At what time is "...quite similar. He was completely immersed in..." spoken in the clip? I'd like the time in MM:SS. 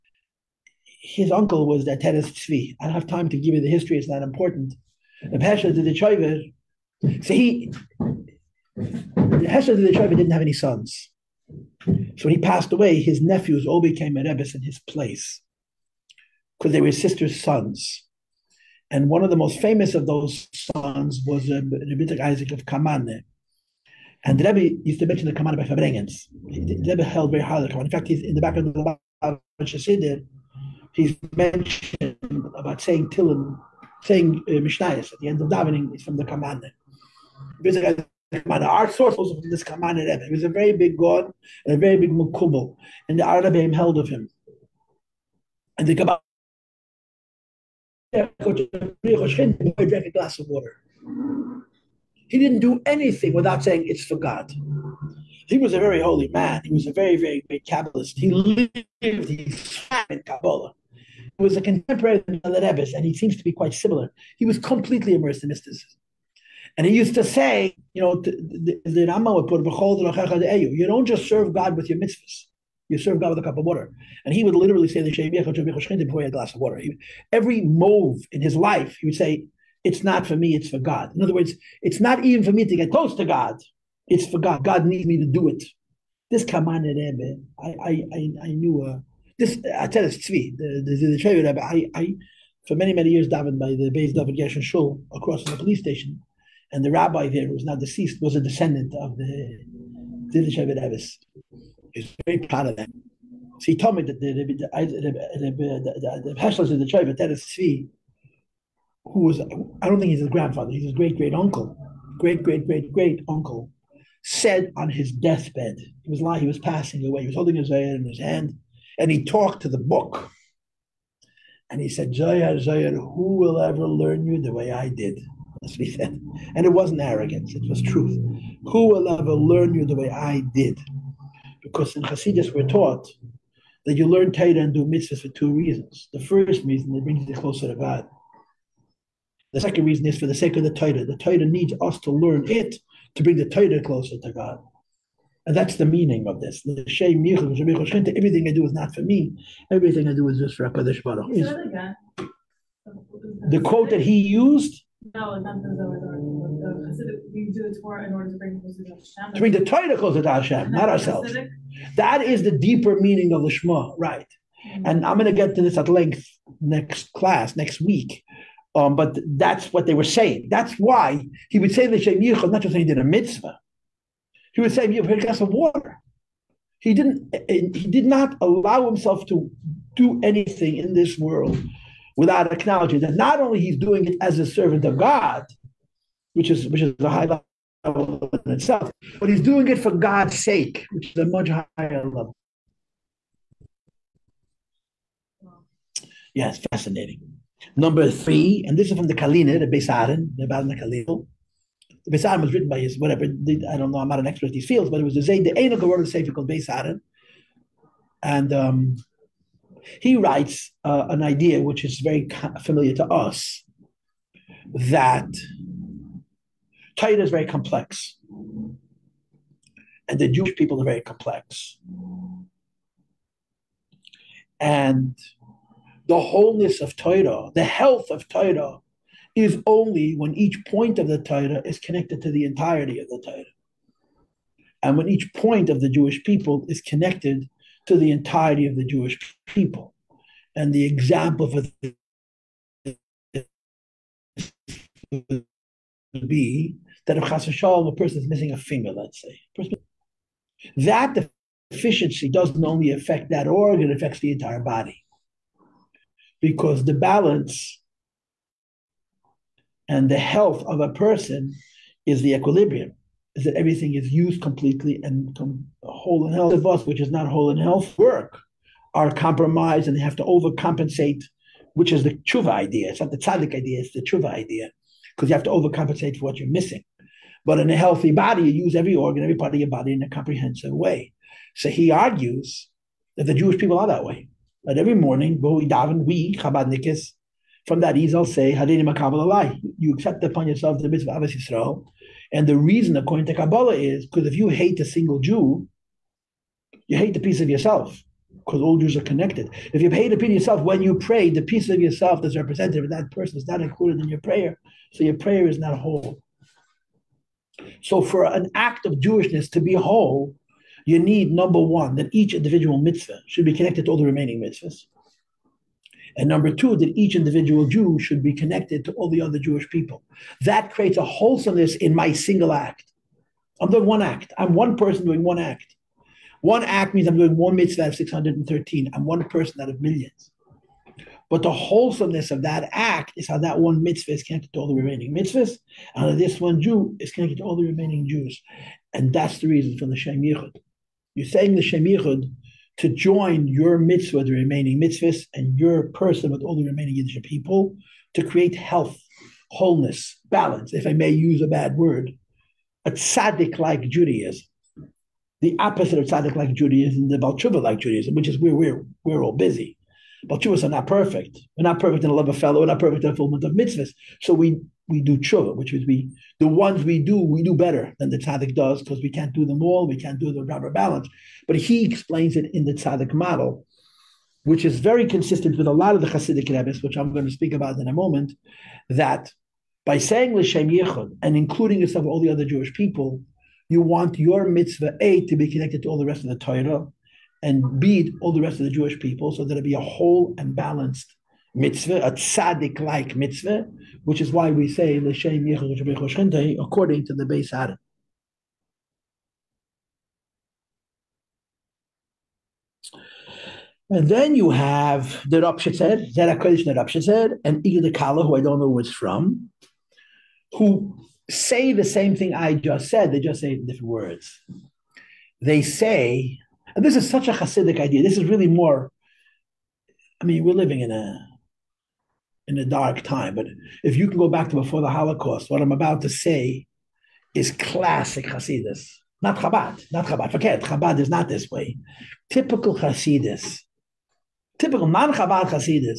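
01:03.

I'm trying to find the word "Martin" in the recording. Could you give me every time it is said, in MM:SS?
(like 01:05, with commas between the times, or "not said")
not said.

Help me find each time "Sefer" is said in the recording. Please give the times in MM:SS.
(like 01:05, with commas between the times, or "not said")
03:26.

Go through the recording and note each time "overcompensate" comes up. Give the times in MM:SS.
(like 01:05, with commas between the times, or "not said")
04:30, 04:35.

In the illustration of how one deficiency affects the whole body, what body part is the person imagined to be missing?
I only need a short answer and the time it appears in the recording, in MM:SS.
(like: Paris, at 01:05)
a finger, at 04:08.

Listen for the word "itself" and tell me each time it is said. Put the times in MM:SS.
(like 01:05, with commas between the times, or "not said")
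03:08.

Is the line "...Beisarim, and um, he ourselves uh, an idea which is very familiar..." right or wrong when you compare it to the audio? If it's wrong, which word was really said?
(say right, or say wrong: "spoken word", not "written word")
wrong: "writes", not "ourselves".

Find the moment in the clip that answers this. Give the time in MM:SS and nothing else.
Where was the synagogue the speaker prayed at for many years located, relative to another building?
01:35.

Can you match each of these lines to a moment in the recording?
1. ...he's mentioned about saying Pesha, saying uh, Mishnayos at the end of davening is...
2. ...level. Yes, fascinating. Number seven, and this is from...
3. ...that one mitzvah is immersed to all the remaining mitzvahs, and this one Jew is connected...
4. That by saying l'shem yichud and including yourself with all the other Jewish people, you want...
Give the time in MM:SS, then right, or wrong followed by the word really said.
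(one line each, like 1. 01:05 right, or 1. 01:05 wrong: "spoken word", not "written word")
1. 00:30 wrong: "Tillim", not "Pesha"
2. 03:12 wrong: "three", not "seven"
3. 05:33 wrong: "connected", not "immersed"
4. 06:18 right.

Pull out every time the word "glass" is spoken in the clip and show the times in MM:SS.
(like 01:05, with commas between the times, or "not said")
00:50, 01:16, 02:55.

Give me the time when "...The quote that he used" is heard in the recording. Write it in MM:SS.
02:33.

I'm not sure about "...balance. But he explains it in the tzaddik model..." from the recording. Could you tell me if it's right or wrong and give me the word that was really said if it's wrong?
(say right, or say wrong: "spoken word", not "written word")
right.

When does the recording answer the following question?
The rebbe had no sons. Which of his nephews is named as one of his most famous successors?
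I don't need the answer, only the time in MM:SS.
00:22.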